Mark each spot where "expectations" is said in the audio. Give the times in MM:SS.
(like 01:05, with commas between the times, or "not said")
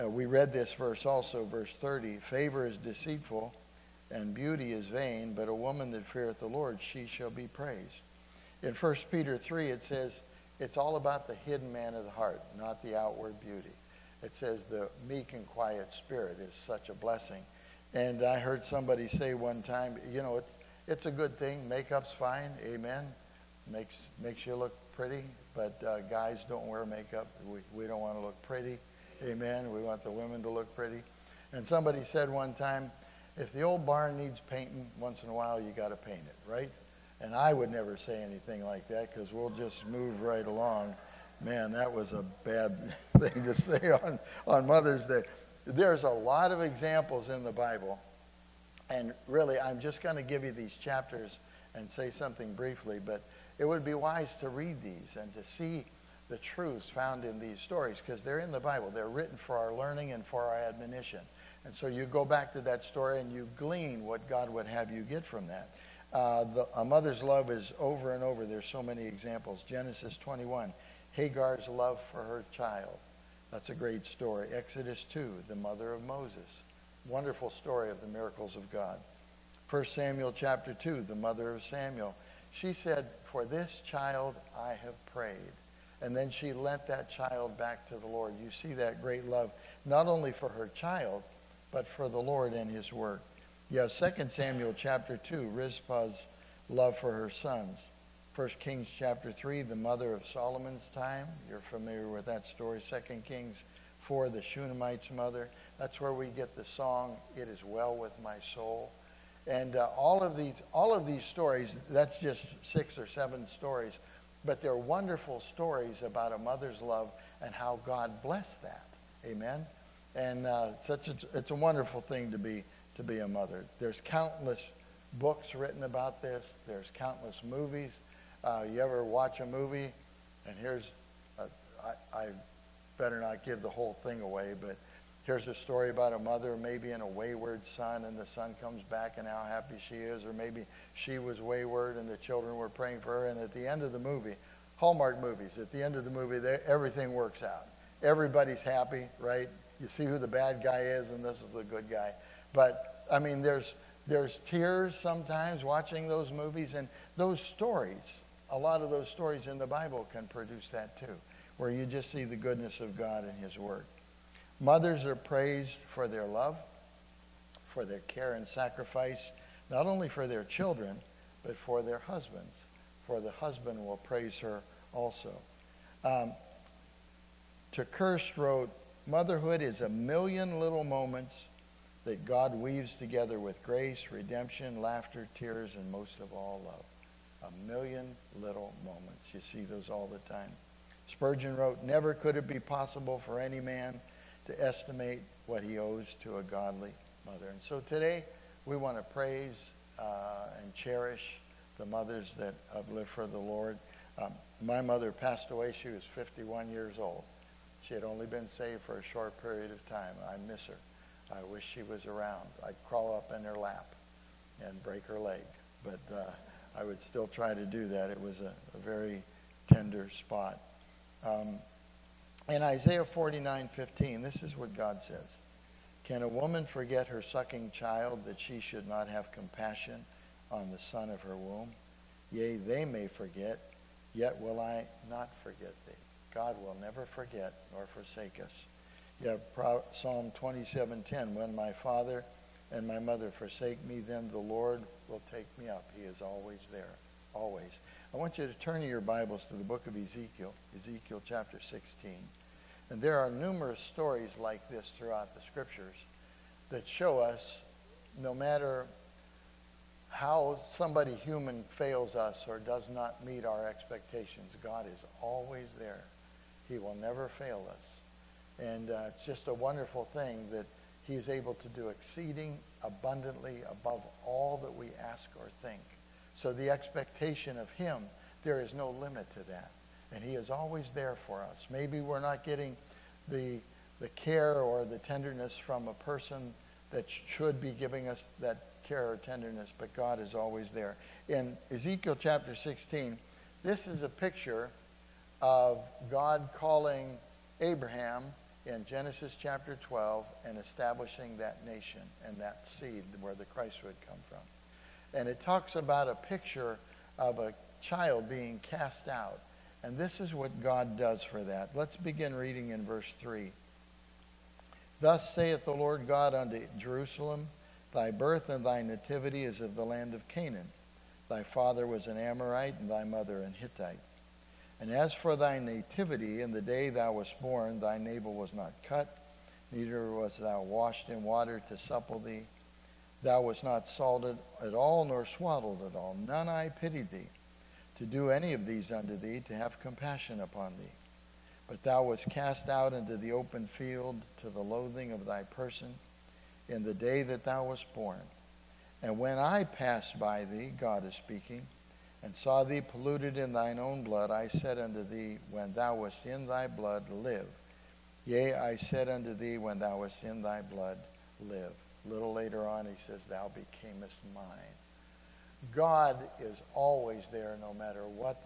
04:23, 04:36.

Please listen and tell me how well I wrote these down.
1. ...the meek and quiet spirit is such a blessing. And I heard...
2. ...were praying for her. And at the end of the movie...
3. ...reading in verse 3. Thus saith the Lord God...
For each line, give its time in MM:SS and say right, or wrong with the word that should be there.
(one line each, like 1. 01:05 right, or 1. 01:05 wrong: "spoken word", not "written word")
1. 00:14 right
2. 02:22 right
3. 05:12 right.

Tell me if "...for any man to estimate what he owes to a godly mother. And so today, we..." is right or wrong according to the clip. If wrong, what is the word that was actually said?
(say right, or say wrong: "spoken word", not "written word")
right.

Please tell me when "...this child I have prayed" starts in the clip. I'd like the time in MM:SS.
01:23.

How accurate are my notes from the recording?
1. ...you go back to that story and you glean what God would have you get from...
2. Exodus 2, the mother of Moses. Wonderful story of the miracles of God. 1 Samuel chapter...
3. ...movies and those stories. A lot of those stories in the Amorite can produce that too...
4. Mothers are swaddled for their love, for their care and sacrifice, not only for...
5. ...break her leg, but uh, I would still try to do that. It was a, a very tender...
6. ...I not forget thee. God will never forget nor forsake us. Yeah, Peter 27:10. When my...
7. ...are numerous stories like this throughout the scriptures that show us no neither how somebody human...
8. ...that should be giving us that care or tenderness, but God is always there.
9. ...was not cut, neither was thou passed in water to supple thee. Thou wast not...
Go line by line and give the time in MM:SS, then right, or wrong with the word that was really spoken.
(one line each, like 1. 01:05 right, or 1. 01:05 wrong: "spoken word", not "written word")
1. 01:01 right
2. 01:14 right
3. 02:36 wrong: "Bible", not "Amorite"
4. 02:44 wrong: "praised", not "swaddled"
5. 03:34 right
6. 03:54 wrong: "Psalm", not "Peter"
7. 04:13 wrong: "matter", not "neither"
8. 04:46 right
9. 05:28 wrong: "washed", not "passed".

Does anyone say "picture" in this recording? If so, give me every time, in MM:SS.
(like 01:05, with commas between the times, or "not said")
04:54, 05:06.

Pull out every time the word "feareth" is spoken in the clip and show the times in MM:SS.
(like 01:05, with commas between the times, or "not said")
00:06.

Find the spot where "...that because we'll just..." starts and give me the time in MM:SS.
00:38.